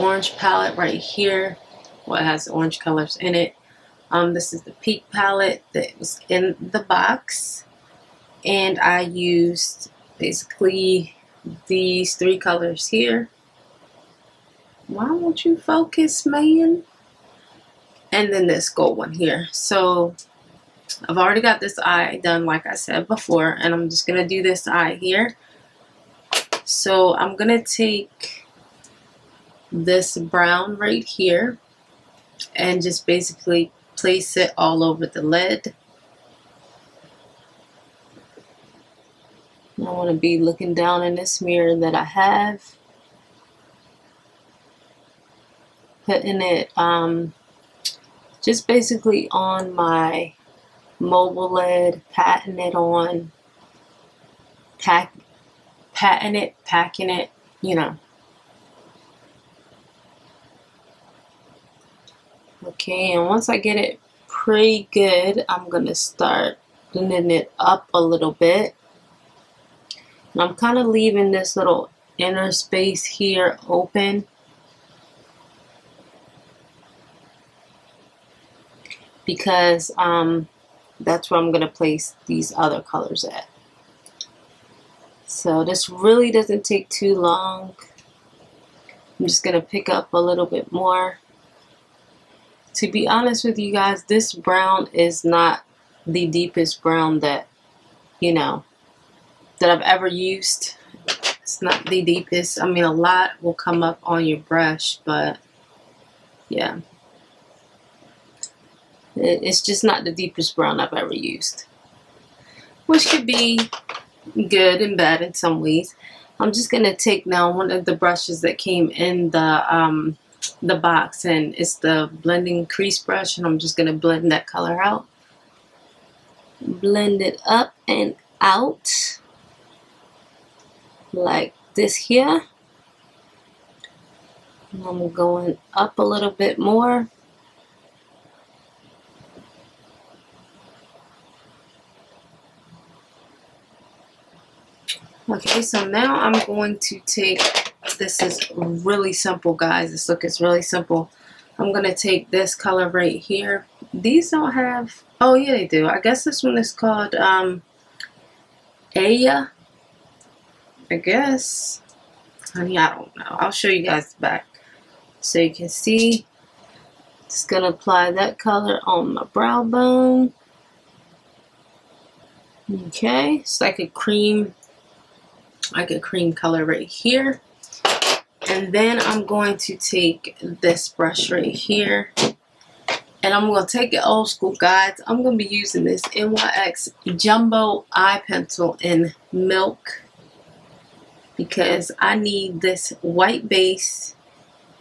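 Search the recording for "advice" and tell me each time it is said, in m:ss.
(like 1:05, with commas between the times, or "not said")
not said.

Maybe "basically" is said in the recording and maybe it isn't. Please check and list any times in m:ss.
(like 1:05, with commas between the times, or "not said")
0:10, 0:33, 0:48.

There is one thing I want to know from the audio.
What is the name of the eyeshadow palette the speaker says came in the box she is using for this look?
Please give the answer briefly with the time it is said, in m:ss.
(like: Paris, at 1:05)
Peak palette, at 0:04.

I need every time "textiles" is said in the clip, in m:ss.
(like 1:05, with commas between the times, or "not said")
not said.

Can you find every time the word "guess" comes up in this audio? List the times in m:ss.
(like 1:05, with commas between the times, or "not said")
2:36, 2:40.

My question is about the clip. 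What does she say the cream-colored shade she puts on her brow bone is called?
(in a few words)
Aya.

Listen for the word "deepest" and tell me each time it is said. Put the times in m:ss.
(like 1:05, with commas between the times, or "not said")
1:36, 1:42, 1:50.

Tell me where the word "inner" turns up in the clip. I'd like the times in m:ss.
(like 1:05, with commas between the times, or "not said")
1:12.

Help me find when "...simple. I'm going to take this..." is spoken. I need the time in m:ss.
2:30.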